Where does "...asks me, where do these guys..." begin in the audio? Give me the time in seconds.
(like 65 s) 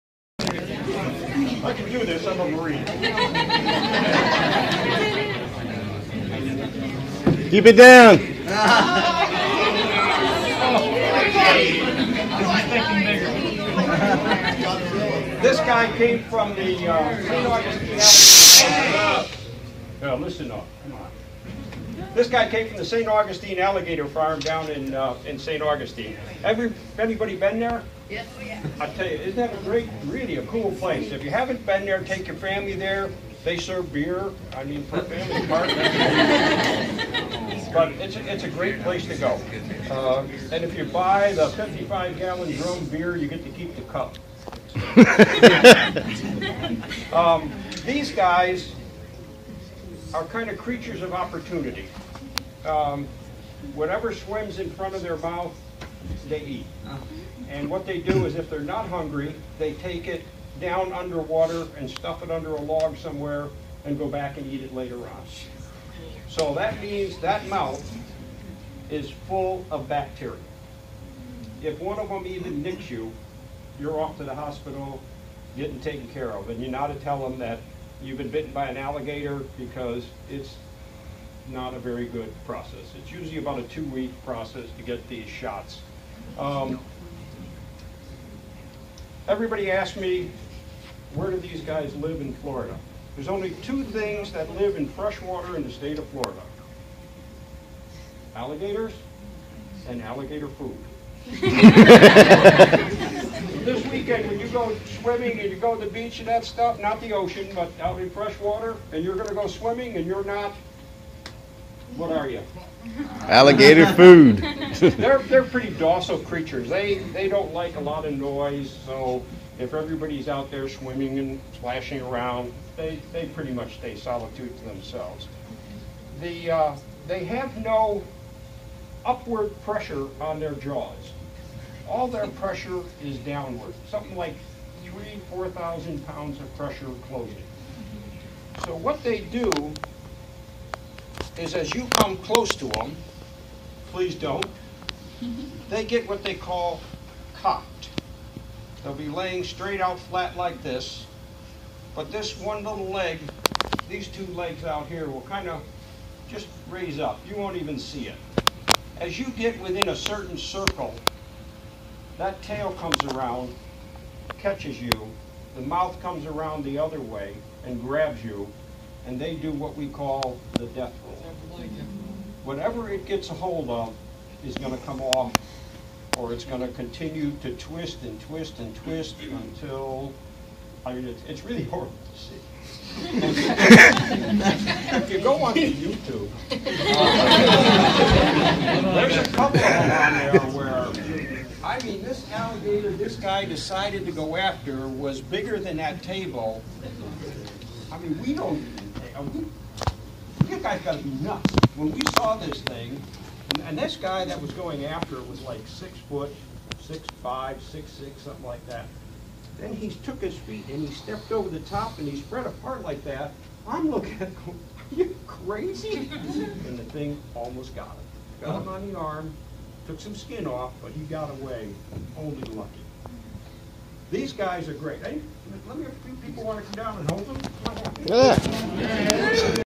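89 s.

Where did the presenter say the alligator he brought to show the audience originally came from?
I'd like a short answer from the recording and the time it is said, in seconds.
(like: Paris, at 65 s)
St. Augustine alligator farm, at 22 s.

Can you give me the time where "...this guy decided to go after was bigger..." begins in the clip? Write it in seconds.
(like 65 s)
192 s.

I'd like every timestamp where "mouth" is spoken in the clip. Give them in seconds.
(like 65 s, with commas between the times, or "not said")
55 s, 67 s, 165 s.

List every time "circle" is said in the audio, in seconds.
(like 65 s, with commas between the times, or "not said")
160 s.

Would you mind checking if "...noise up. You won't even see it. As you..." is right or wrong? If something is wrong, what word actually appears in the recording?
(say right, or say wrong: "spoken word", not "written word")
wrong: "raise", not "noise".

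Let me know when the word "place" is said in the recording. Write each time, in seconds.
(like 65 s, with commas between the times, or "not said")
30 s, 38 s.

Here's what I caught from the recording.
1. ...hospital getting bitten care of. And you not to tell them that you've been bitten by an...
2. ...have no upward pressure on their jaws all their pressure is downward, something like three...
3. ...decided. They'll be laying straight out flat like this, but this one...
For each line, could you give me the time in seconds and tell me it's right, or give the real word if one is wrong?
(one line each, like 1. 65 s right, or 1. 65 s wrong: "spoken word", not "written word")
1. 74 s wrong: "taken", not "bitten"
2. 127 s right
3. 147 s wrong: "cocked", not "decided".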